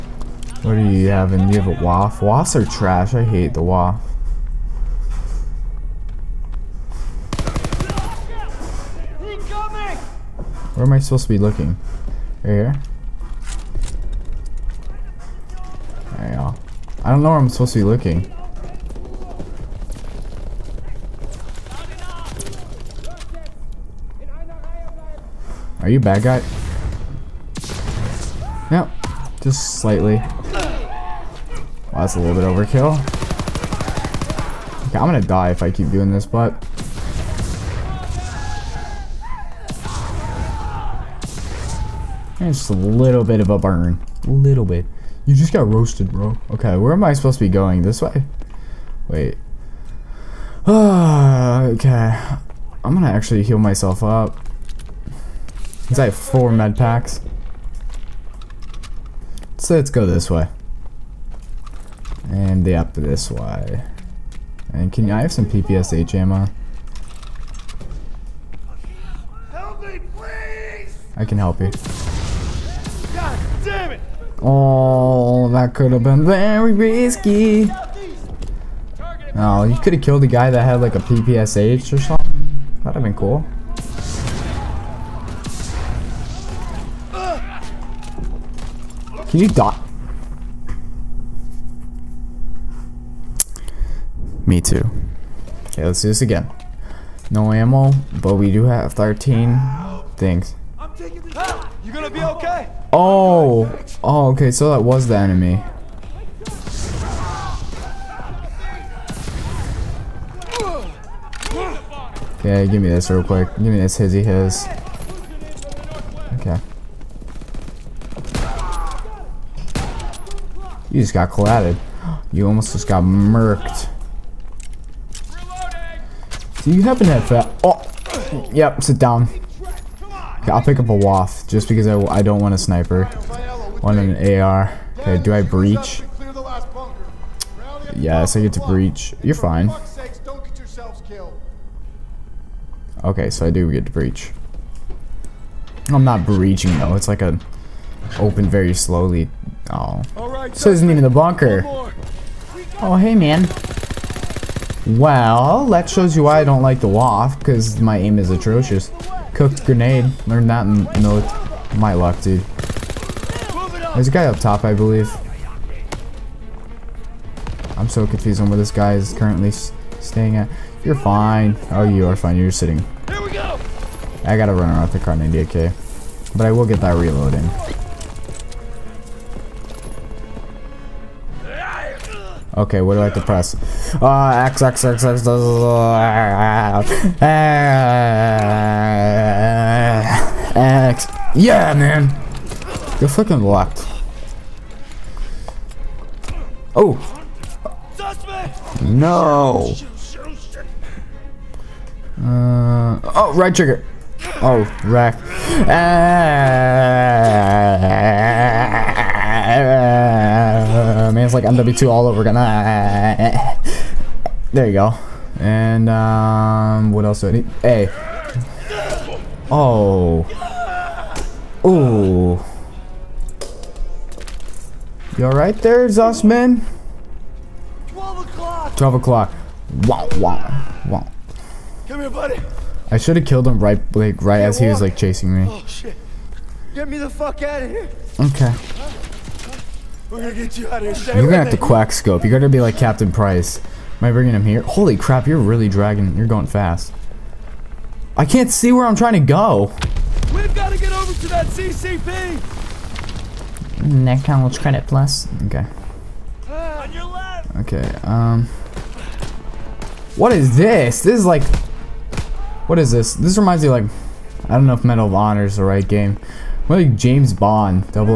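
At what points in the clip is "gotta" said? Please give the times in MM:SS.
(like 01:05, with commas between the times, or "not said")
02:54, 04:02, 04:10.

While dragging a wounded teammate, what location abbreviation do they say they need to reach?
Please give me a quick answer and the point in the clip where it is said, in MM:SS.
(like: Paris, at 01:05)
CCP, at 04:11.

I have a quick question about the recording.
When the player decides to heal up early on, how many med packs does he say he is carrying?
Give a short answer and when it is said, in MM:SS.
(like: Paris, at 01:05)
4, at 00:56.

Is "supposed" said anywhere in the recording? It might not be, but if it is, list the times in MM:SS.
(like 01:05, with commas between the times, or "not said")
00:10, 00:17, 00:47.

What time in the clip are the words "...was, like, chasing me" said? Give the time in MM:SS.
03:54.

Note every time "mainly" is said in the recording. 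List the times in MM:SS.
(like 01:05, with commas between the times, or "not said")
not said.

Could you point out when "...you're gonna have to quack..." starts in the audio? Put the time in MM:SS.
04:01.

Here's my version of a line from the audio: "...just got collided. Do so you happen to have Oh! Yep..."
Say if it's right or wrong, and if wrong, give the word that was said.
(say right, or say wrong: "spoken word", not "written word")
wrong: "murked", not "collided".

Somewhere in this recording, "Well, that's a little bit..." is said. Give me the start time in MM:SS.
00:30.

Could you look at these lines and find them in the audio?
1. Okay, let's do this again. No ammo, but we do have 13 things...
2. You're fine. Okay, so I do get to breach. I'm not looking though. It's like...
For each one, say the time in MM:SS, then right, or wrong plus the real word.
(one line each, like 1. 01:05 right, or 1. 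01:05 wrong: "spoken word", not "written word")
1. 01:35 right
2. 02:19 wrong: "breaching", not "looking".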